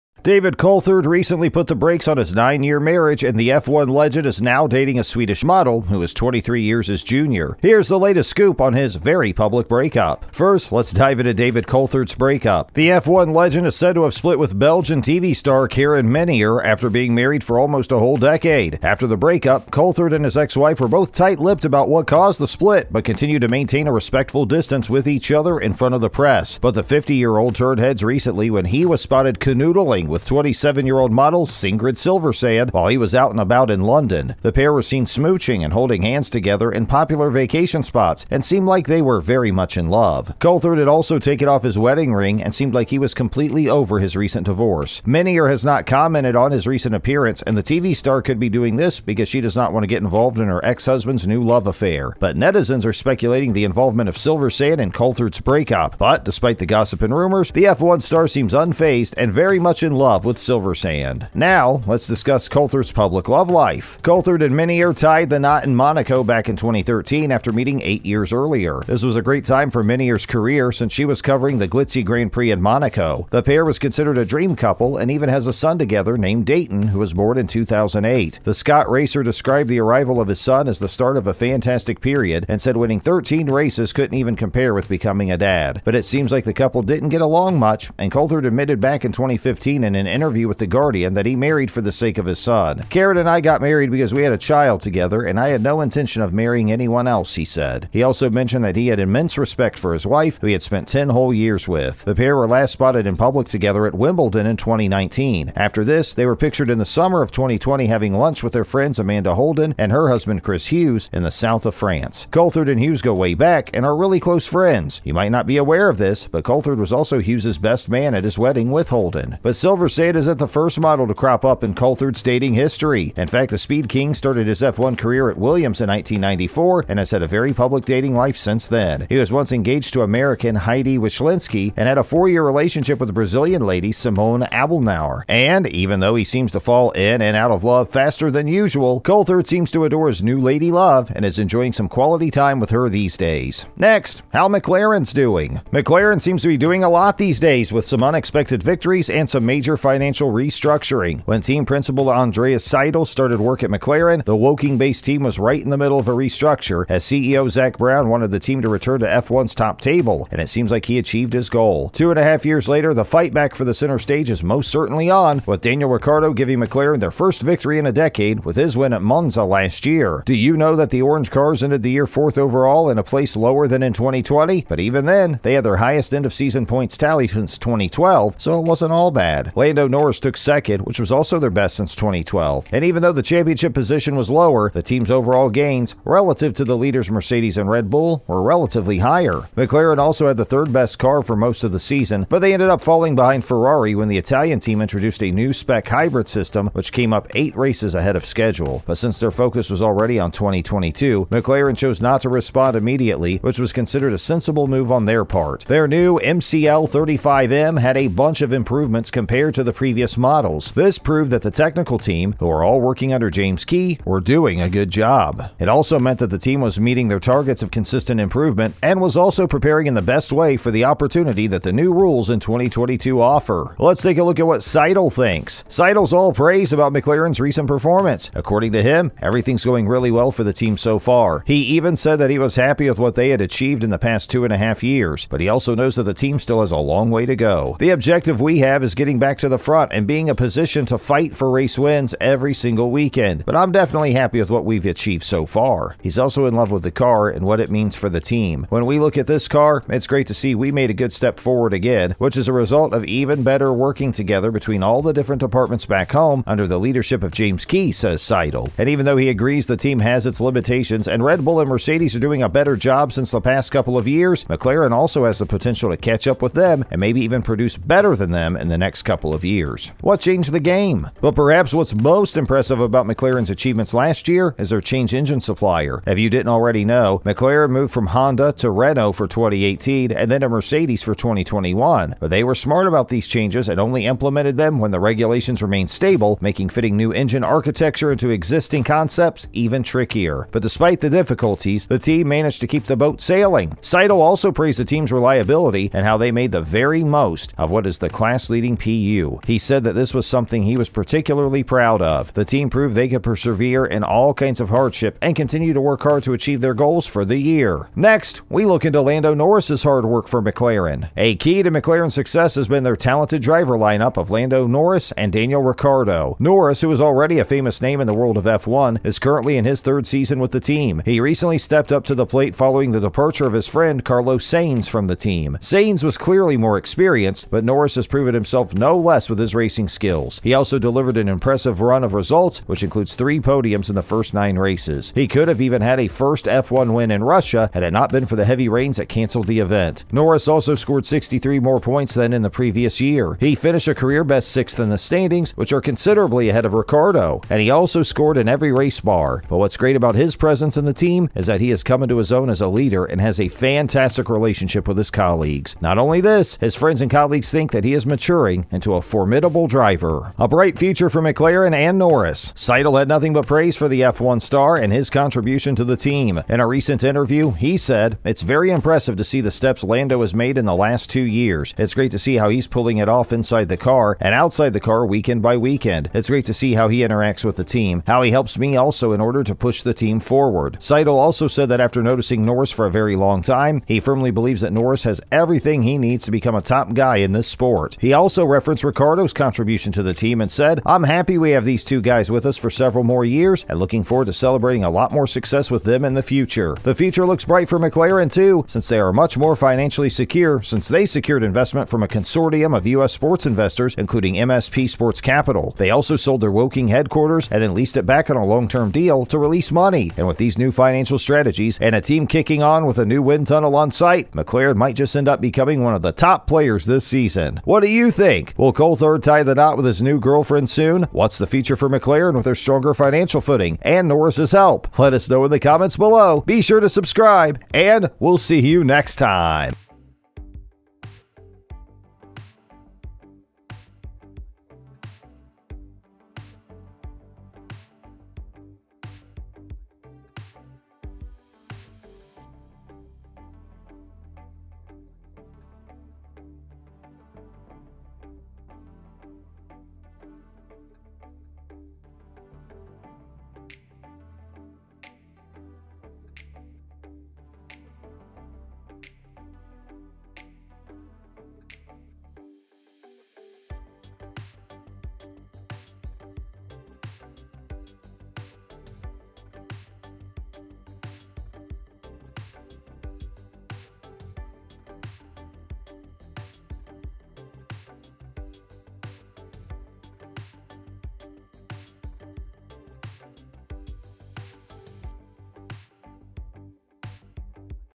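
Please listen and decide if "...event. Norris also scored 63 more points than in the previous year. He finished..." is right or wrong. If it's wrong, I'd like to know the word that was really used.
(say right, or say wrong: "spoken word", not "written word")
right.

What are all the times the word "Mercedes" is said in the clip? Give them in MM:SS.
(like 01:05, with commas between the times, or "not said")
03:07, 04:21, 04:40.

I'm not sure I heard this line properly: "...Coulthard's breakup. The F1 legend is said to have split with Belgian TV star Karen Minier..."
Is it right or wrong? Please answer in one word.
right.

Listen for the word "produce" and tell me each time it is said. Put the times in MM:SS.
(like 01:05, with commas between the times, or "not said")
04:27.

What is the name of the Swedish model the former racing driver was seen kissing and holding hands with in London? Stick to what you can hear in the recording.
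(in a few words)
Sigrid Silversand.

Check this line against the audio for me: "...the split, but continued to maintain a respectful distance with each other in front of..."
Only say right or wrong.
right.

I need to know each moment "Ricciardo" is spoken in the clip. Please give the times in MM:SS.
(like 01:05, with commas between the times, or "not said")
02:45, 05:15, 05:46, 06:28.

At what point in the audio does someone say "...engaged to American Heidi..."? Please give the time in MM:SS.
02:09.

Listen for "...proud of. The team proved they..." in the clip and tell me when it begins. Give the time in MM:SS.
05:01.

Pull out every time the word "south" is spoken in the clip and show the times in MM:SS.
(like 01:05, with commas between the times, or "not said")
01:51.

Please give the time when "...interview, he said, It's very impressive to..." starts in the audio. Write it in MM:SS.
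06:07.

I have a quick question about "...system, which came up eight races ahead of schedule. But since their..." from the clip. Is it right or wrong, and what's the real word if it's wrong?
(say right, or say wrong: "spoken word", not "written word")
right.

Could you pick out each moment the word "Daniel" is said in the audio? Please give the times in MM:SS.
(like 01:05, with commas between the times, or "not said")
02:45, 05:15.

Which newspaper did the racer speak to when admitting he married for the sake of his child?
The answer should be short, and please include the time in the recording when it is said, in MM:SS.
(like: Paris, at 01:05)
The Guardian, at 01:30.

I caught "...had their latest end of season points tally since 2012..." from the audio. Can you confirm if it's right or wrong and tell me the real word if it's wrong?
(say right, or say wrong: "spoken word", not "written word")
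wrong: "highest", not "latest".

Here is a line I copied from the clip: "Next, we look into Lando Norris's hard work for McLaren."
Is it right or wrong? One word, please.
right.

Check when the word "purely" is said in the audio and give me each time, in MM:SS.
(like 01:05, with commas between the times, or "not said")
not said.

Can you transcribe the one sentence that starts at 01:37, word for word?
He also mentioned that he had immense respect for his wife, who he had spent 10 whole years with.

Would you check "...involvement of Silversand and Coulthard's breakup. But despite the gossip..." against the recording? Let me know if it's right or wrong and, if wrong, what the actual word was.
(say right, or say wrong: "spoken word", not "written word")
right.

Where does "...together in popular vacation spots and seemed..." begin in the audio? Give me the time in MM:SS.
00:36.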